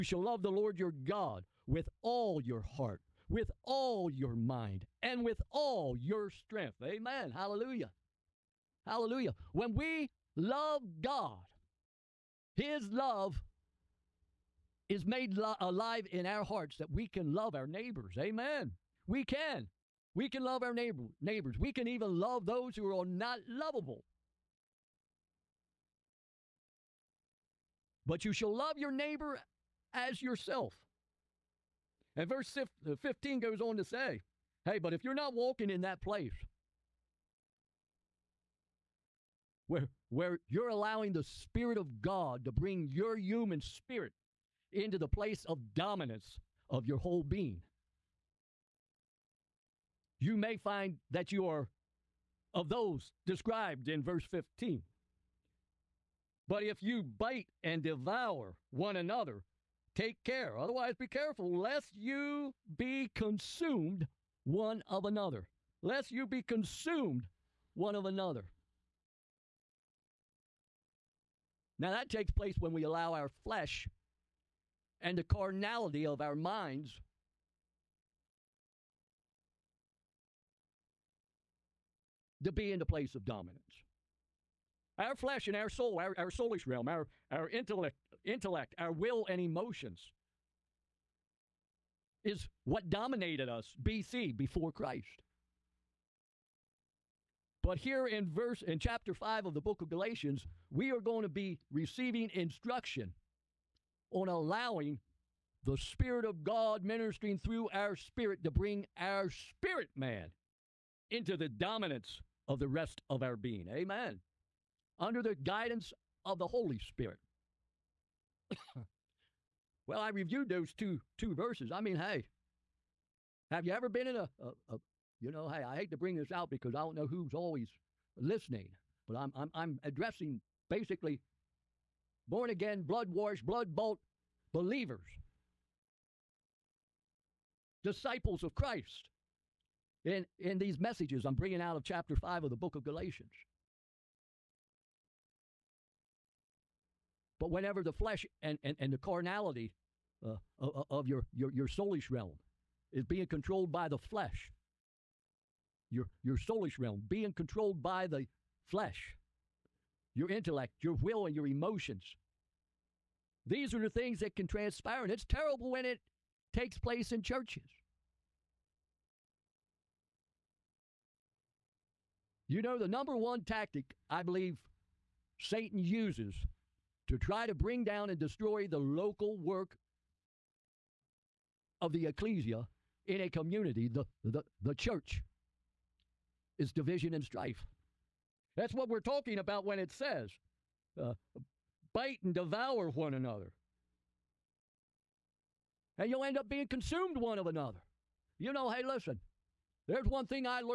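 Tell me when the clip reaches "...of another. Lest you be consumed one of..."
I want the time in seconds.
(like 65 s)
64 s.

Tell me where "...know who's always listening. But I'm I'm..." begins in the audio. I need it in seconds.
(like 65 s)
126 s.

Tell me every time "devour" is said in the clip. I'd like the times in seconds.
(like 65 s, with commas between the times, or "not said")
57 s, 192 s.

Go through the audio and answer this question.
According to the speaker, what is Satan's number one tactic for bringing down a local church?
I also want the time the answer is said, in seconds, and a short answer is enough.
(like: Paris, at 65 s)
division and strife, at 186 s.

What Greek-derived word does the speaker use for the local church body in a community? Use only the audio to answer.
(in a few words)
ecclesia.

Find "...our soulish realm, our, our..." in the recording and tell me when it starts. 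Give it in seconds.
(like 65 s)
86 s.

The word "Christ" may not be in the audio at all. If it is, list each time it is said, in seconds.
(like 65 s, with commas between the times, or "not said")
94 s, 138 s.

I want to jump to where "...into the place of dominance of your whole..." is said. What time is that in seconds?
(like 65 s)
44 s.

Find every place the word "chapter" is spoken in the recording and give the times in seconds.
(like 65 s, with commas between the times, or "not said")
98 s, 141 s.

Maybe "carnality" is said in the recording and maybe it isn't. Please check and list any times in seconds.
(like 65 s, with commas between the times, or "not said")
75 s, 148 s.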